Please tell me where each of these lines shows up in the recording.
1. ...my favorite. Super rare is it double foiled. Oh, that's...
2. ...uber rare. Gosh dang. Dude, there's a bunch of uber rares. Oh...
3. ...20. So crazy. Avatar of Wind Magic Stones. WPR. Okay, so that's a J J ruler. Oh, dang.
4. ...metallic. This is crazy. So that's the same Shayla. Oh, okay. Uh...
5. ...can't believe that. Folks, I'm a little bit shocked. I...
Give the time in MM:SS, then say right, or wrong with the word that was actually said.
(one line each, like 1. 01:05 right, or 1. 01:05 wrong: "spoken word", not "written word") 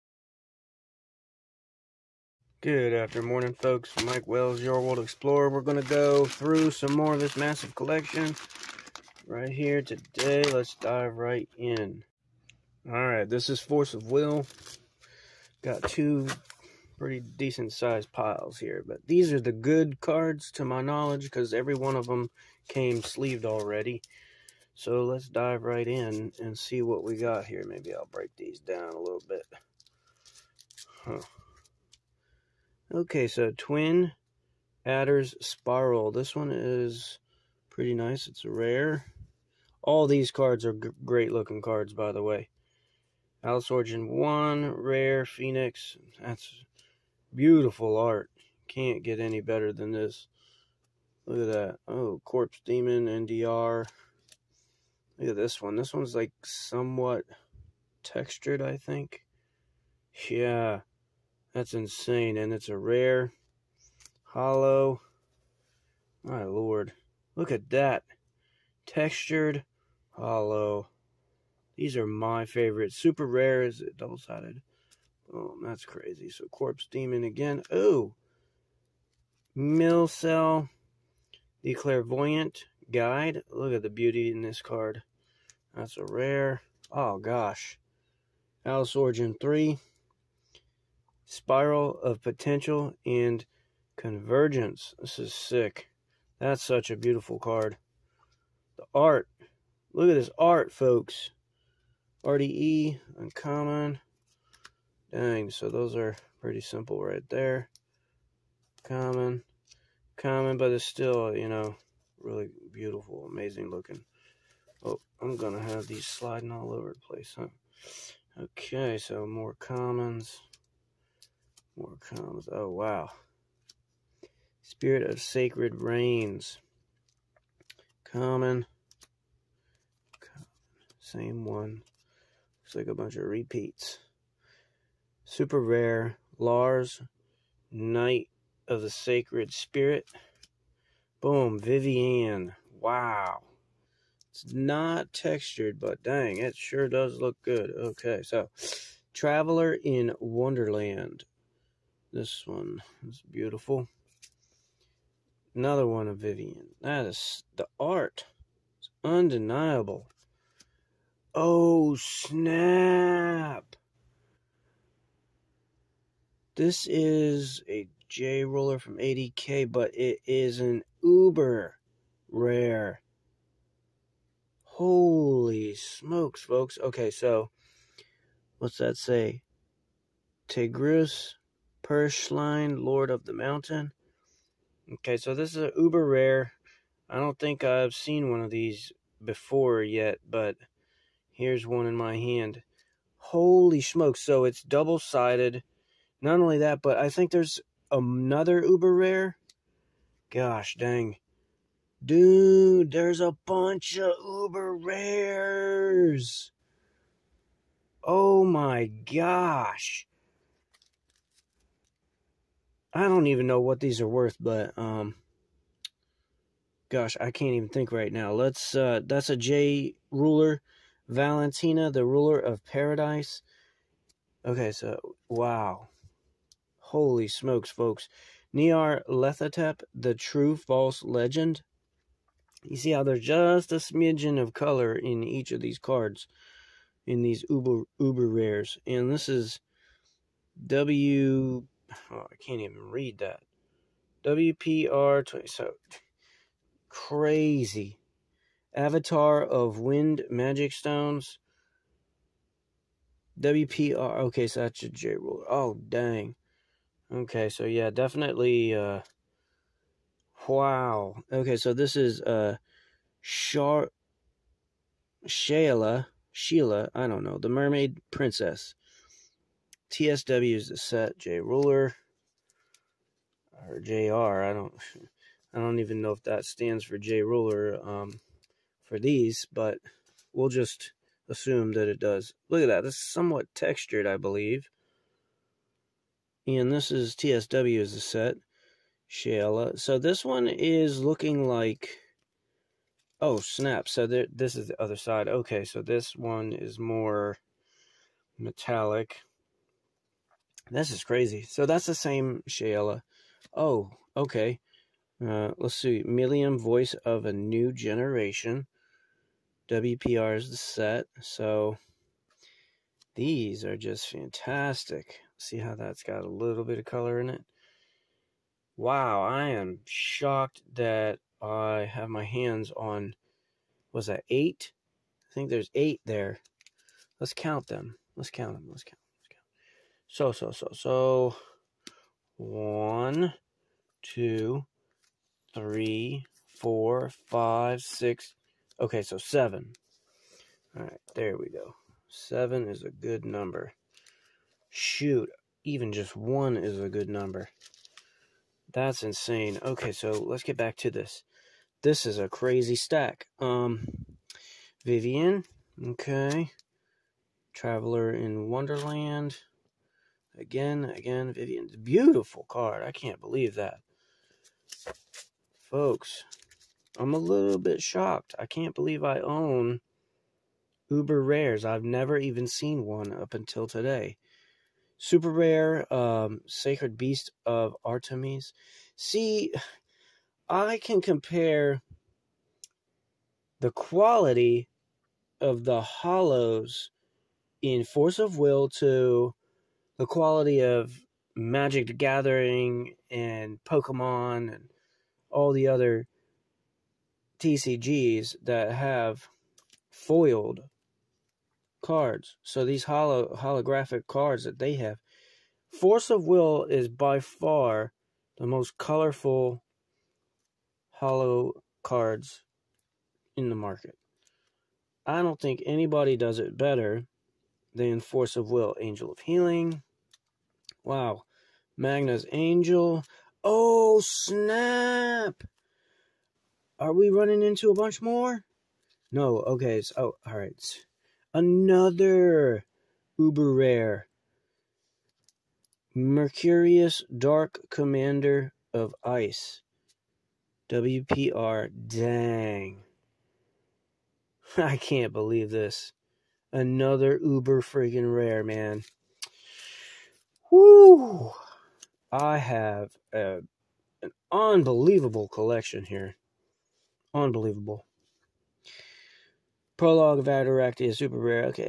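1. 01:12 wrong: "sided", not "foiled"
2. 03:18 right
3. 04:05 right
4. 04:58 right
5. 06:02 right.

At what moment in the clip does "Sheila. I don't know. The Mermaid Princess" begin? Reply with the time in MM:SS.
04:26.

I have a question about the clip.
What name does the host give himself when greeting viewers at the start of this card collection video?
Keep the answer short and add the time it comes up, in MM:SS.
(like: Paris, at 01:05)
Mike Wells, at 00:04.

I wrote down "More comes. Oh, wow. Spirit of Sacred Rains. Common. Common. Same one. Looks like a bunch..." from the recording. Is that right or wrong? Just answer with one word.
right.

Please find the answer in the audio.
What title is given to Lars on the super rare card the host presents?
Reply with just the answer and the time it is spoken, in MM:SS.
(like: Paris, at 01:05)
Knight of the Sacred Spirit, at 02:17.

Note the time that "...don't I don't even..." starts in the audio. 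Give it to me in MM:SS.
04:34.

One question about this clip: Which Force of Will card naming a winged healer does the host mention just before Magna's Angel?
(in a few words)
Angel of Healing.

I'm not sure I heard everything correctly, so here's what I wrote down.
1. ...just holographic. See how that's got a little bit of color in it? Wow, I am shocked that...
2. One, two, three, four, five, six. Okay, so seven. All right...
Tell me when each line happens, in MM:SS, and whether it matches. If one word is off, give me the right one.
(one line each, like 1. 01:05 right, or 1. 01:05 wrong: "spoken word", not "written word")
1. 05:13 wrong: "fantastic", not "holographic"
2. 05:32 right.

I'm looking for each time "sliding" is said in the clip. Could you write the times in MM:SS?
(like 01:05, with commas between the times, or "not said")
01:56.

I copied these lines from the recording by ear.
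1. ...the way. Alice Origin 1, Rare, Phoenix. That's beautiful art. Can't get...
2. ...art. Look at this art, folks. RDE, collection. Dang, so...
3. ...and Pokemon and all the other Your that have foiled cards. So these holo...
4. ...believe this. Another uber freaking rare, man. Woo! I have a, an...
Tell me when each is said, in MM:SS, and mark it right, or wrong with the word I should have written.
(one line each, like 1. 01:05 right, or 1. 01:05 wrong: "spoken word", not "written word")
1. 00:42 right
2. 01:38 wrong: "uncommon", not "collection"
3. 06:33 wrong: "TCGs", not "Your"
4. 07:25 right.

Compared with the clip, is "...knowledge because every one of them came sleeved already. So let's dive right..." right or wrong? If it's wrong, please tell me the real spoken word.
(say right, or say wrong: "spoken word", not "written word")
right.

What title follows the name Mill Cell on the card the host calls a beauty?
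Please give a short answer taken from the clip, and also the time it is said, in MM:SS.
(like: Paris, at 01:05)
The Clairvoyant Guide, at 01:21.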